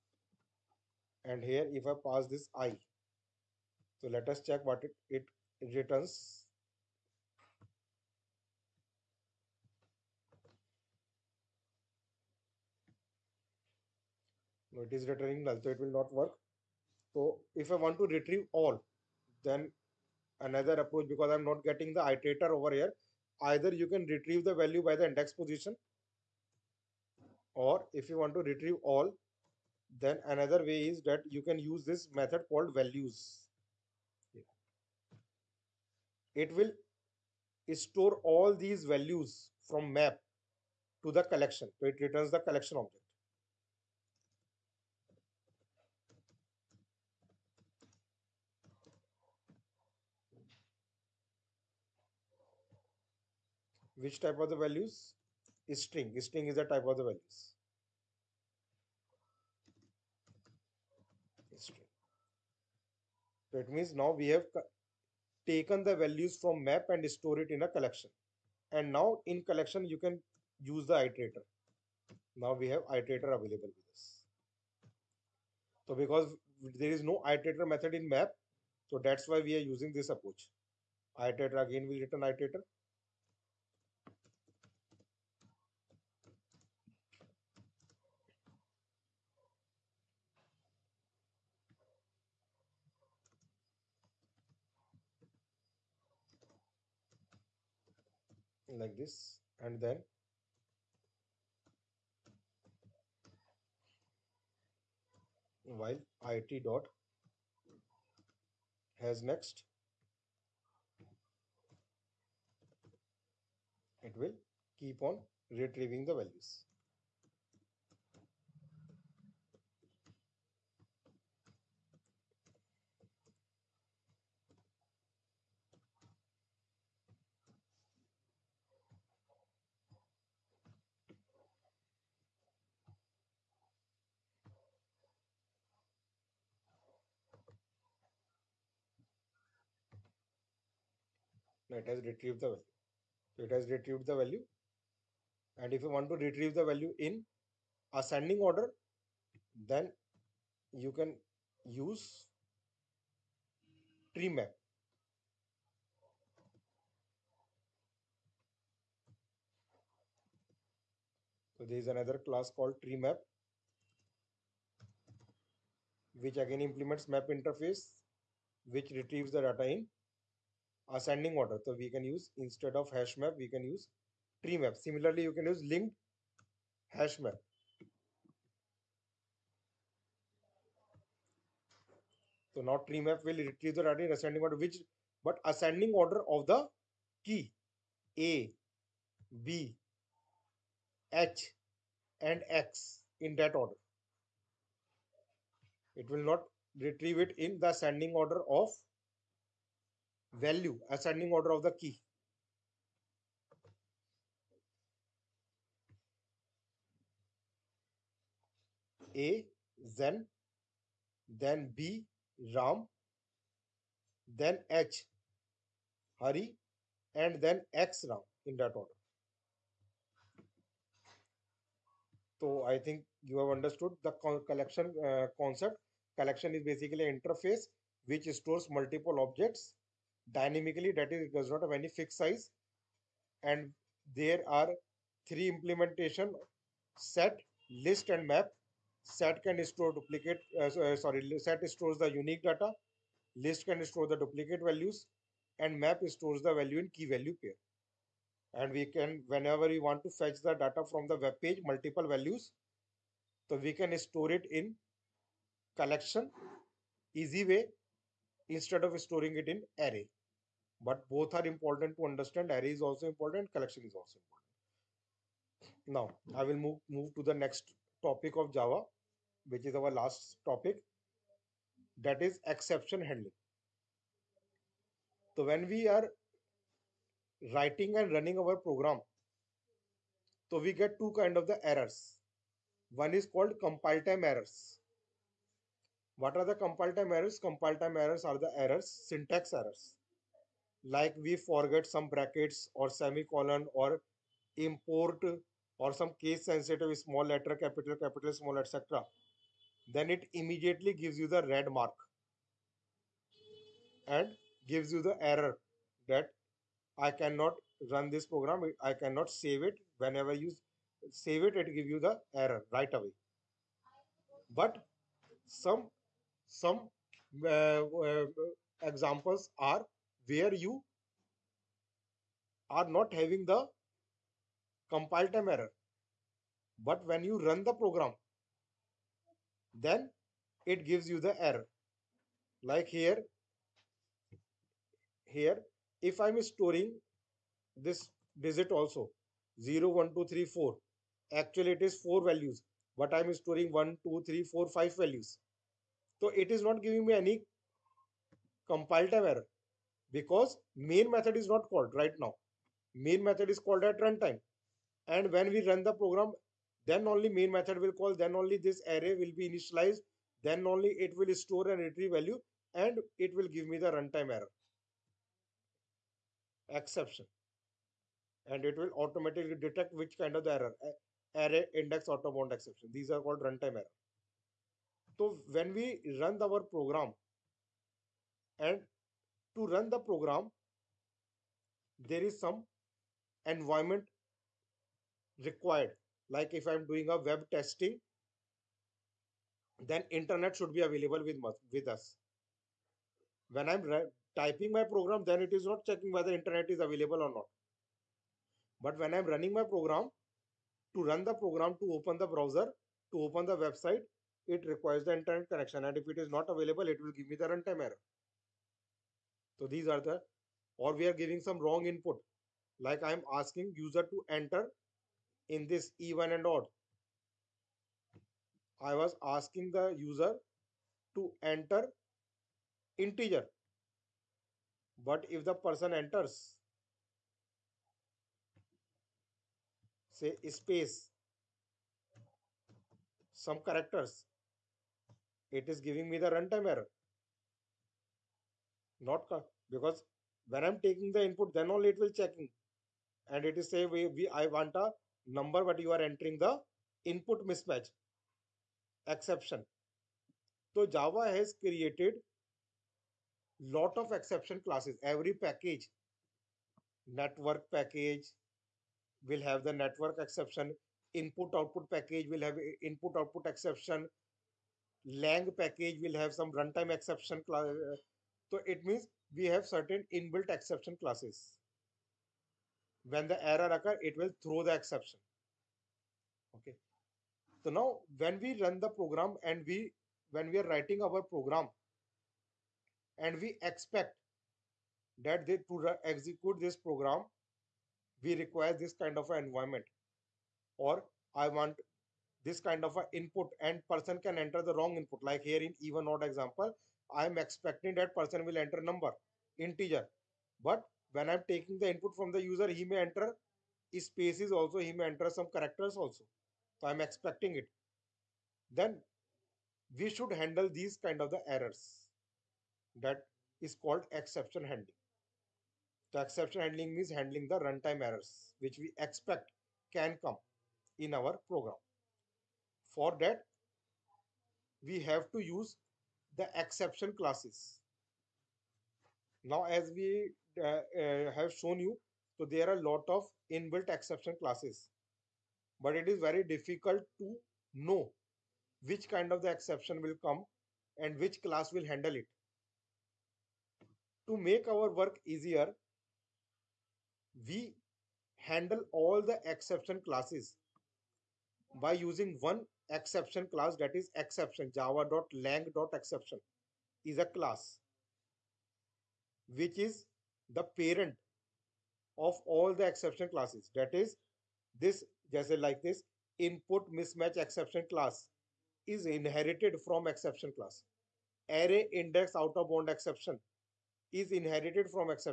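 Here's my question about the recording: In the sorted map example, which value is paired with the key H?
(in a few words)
Hari.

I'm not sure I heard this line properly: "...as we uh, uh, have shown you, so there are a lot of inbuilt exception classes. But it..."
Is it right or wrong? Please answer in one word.
right.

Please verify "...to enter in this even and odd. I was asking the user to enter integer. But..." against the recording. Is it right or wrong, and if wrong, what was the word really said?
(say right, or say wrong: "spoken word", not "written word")
right.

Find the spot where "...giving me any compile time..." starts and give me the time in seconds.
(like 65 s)
346 s.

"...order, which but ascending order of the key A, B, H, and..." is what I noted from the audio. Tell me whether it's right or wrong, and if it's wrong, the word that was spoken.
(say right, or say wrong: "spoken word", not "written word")
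right.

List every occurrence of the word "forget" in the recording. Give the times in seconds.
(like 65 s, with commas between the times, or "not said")
291 s.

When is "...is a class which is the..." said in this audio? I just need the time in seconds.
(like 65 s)
557 s.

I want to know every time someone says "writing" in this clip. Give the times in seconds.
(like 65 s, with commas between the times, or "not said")
277 s, 480 s.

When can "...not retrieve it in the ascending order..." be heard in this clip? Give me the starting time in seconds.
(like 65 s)
196 s.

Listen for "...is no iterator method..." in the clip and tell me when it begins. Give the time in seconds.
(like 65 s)
76 s.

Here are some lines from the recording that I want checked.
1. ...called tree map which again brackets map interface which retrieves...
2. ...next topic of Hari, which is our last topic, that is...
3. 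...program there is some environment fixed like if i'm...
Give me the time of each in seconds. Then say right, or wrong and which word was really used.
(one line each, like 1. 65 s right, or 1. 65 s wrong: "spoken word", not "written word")
1. 162 s wrong: "implements", not "brackets"
2. 267 s wrong: "Java", not "Hari"
3. 380 s wrong: "required", not "fixed".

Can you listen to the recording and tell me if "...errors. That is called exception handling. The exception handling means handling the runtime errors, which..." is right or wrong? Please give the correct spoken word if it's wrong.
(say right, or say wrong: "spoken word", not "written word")
right.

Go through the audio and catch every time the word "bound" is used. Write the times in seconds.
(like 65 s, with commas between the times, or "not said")
372 s, 572 s.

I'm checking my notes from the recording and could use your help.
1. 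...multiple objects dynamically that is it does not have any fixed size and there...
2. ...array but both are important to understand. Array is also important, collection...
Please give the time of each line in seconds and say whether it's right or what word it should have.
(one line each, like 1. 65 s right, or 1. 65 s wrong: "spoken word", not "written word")
1. 228 s right
2. 259 s right.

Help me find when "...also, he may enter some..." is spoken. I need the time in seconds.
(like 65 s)
504 s.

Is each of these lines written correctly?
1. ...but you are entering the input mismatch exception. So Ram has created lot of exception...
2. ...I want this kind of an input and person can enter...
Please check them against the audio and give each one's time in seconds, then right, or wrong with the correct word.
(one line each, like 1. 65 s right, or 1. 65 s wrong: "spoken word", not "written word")
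1. 445 s wrong: "Java", not "Ram"
2. 491 s right.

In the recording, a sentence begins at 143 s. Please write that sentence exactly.
So it has retrieved the value.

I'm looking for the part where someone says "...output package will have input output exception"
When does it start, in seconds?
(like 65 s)
461 s.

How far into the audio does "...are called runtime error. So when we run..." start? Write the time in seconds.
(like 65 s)
373 s.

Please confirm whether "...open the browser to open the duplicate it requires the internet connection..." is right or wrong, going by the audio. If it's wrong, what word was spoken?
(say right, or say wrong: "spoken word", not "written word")
wrong: "website", not "duplicate".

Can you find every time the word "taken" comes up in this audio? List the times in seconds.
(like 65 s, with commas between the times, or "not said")
65 s.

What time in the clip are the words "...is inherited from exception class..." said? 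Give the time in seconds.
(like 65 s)
568 s.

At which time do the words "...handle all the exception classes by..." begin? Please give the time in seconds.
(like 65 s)
548 s.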